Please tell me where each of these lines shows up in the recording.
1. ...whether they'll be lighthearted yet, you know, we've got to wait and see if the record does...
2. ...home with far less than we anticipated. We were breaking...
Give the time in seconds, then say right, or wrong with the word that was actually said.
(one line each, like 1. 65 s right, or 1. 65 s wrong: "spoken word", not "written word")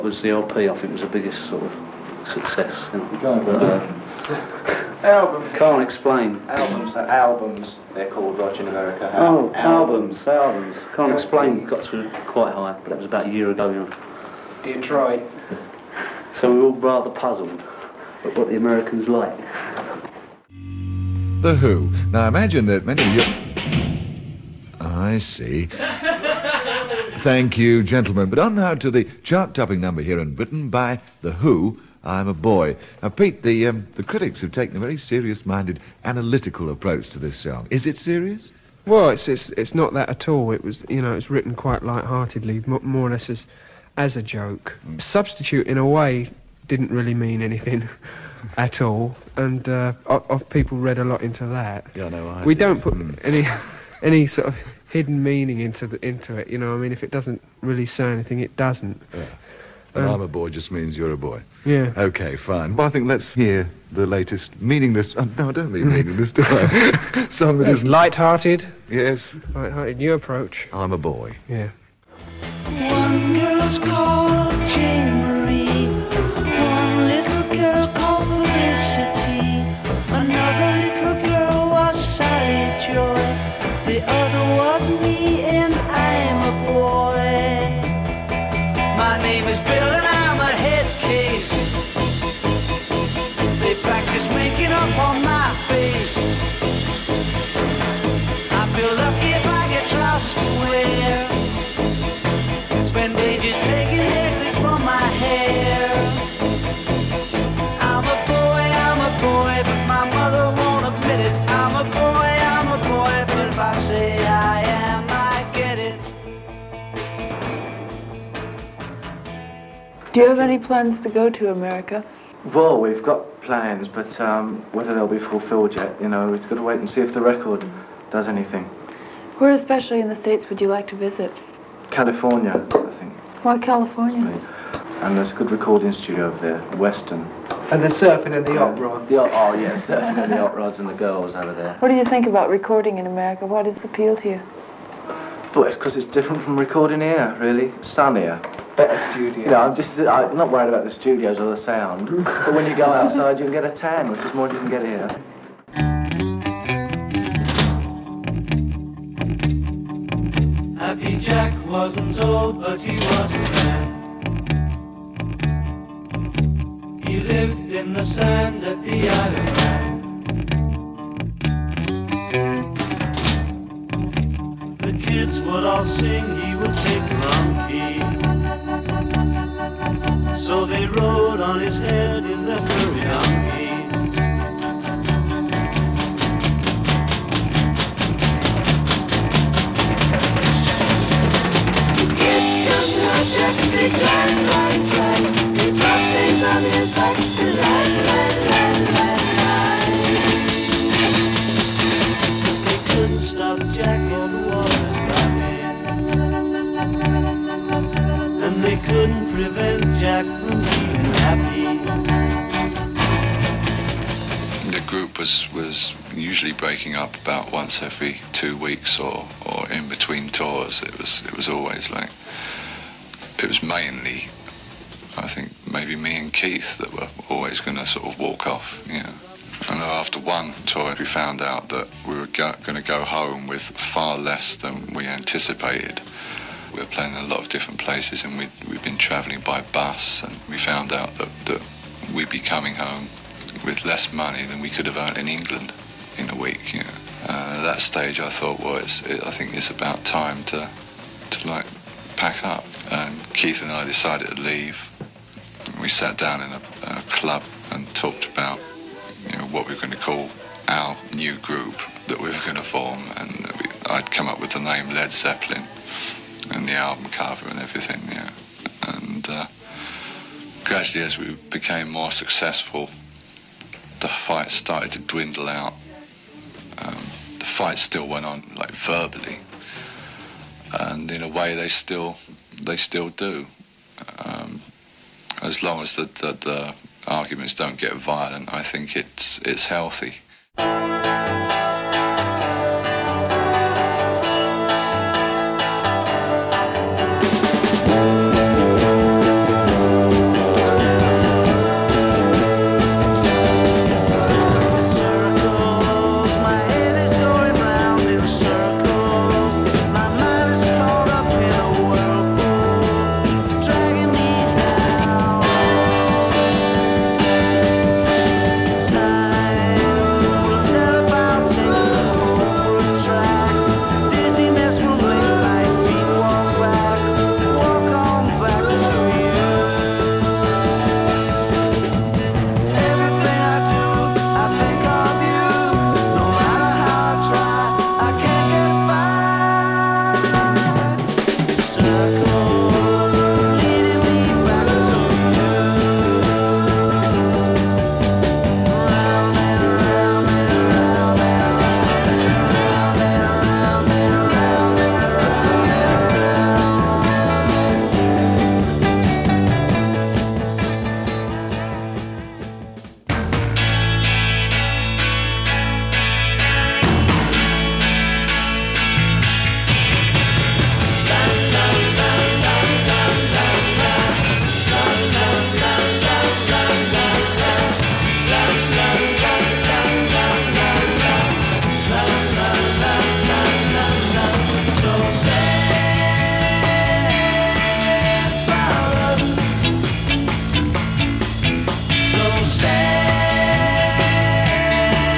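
1. 124 s wrong: "fulfilled", not "lighthearted"
2. 233 s wrong: "playing", not "breaking".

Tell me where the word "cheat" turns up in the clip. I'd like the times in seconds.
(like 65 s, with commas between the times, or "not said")
not said.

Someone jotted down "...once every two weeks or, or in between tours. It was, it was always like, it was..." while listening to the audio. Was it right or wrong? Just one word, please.
right.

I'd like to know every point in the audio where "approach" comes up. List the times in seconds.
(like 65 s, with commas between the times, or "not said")
36 s, 70 s.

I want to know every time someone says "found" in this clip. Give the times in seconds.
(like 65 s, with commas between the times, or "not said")
231 s, 240 s.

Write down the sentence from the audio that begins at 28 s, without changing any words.
But on now to the chart-topping number here in Britain by The Who, I'm a Boy.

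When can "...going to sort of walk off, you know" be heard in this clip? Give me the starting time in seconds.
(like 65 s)
227 s.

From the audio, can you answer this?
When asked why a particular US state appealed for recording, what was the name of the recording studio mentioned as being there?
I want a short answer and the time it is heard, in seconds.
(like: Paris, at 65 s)
Western, at 136 s.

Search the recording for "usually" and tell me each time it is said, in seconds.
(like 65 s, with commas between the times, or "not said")
216 s.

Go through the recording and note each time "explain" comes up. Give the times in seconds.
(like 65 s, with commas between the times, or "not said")
5 s, 11 s.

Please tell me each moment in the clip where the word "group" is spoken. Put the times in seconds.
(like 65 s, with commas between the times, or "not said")
214 s, 261 s.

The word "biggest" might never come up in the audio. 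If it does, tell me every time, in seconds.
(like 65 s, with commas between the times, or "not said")
1 s.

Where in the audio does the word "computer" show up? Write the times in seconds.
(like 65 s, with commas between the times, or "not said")
not said.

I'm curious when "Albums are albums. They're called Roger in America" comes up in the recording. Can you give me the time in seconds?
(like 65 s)
6 s.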